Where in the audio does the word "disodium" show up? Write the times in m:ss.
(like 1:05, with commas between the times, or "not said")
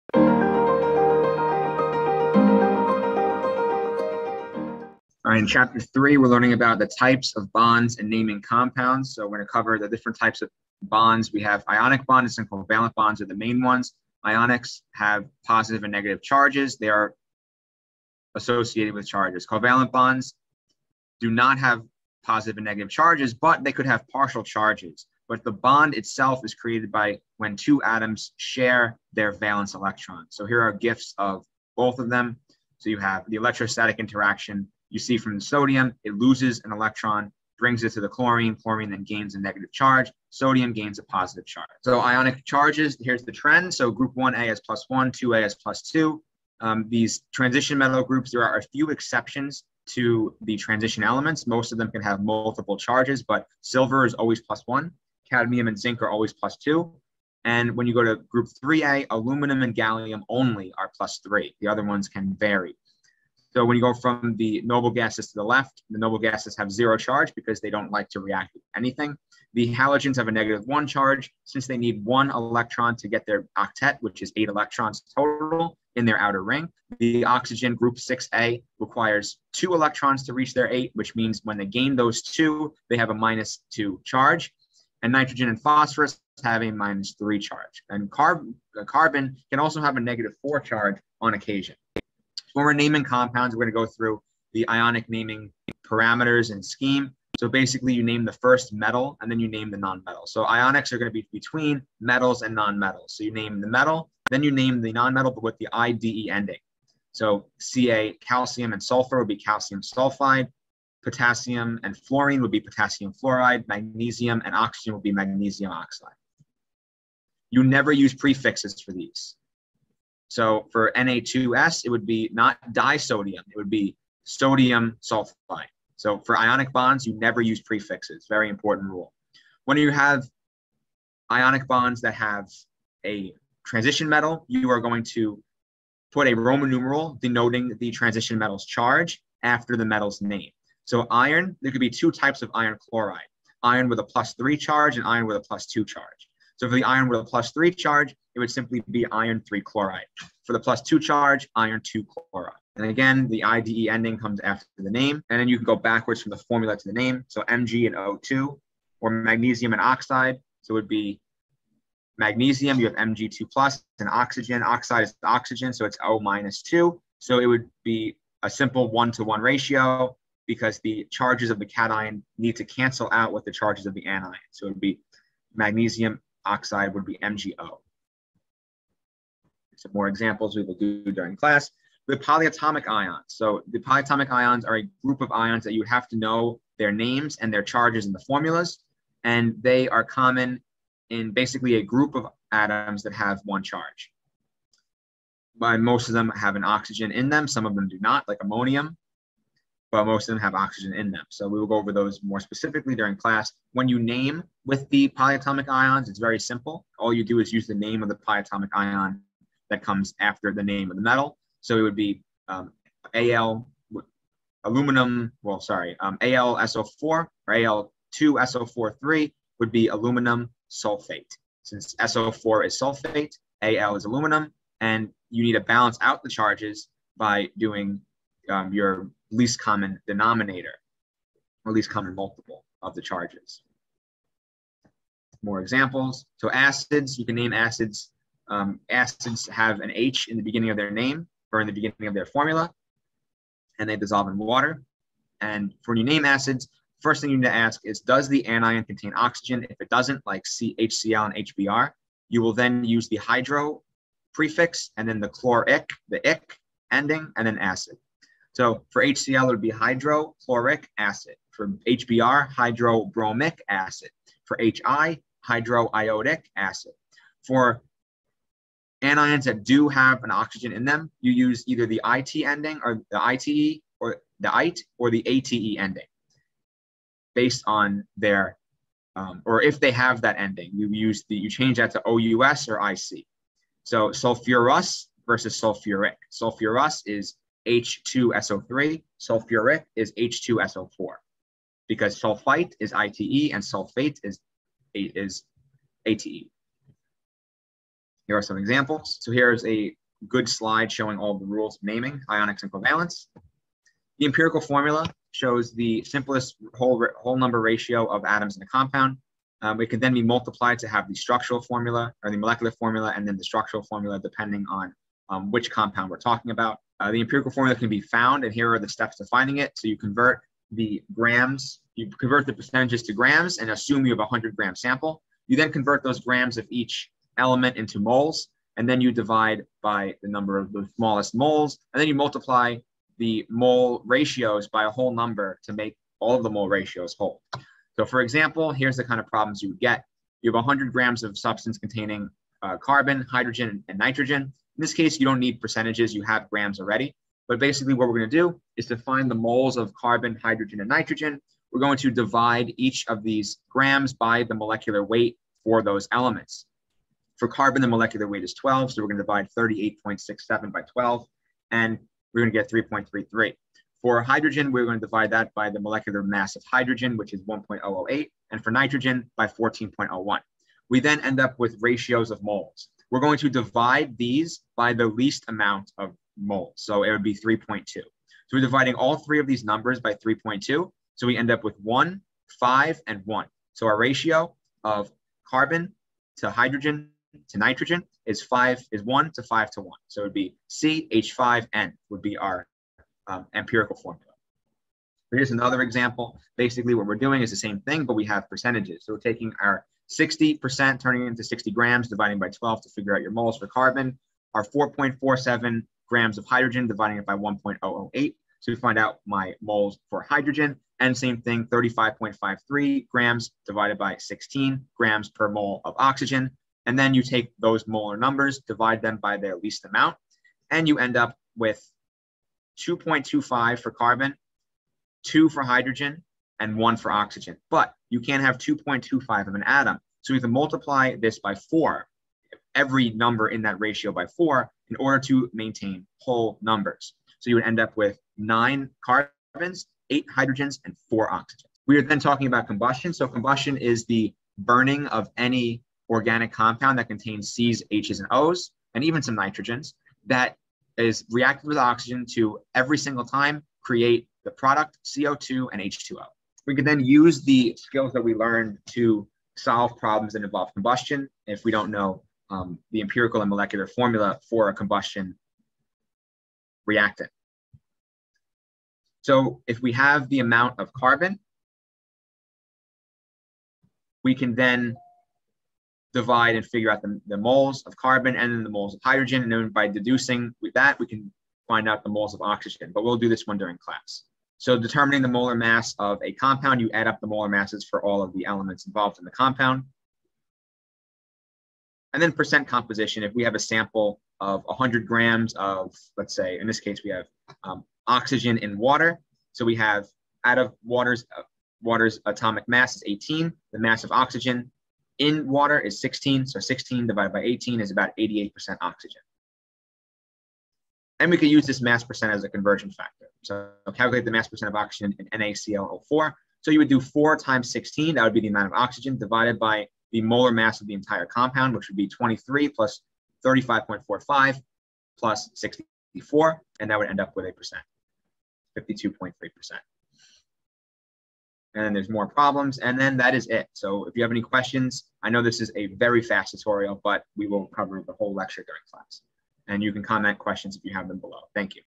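2:02.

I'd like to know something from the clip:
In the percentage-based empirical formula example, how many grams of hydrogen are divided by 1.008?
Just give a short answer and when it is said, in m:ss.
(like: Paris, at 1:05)
4.47, at 6:44.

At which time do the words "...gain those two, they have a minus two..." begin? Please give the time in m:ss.
1:21.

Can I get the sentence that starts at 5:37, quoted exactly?
So for example, here's the kind of problems you would get.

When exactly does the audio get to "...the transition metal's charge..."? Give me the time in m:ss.
2:17.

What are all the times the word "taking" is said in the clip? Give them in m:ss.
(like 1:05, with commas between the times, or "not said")
6:39.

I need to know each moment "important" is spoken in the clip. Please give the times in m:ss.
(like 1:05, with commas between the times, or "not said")
2:08.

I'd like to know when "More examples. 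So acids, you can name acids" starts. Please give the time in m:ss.
3:55.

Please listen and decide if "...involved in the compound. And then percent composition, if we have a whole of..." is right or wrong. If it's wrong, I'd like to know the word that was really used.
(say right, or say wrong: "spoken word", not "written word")
wrong: "sample", not "whole".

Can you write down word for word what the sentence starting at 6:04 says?
For hydrogen, we're going to divide that by the molecular mass of hydrogen, which is 1.008, and for nitrogen by 14.01.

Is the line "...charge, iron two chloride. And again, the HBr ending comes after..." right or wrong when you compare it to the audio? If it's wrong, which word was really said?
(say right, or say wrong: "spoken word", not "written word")
wrong: "IDE", not "HBr".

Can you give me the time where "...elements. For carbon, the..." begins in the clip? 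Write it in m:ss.
5:56.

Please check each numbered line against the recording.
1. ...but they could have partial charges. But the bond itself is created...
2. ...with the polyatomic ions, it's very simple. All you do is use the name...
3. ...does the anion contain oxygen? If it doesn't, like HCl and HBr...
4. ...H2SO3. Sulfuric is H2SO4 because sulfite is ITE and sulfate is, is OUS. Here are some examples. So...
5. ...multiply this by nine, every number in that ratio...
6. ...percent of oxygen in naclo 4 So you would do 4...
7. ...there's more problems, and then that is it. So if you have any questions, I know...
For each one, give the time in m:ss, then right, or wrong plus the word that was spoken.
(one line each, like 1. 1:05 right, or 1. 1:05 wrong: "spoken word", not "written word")
1. 0:23 right
2. 3:24 right
3. 4:08 right
4. 4:47 wrong: "ATE", not "OUS"
5. 7:10 wrong: "four", not "nine"
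6. 8:34 right
7. 8:51 right.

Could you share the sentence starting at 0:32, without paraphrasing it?
So you have the electrostatic interaction you see from the sodium, it loses an electron, brings it to the chlorine.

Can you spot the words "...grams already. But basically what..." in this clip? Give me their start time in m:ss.
5:46.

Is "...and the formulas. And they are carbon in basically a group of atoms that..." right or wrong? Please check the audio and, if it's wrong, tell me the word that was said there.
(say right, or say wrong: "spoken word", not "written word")
wrong: "common", not "carbon".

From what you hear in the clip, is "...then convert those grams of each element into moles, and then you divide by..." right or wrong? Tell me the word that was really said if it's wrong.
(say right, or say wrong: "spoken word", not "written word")
right.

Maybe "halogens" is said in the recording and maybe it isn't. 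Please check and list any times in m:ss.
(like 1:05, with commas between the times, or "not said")
1:09.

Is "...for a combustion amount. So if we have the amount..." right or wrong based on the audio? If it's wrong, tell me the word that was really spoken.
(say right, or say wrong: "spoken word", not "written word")
wrong: "reactant", not "amount".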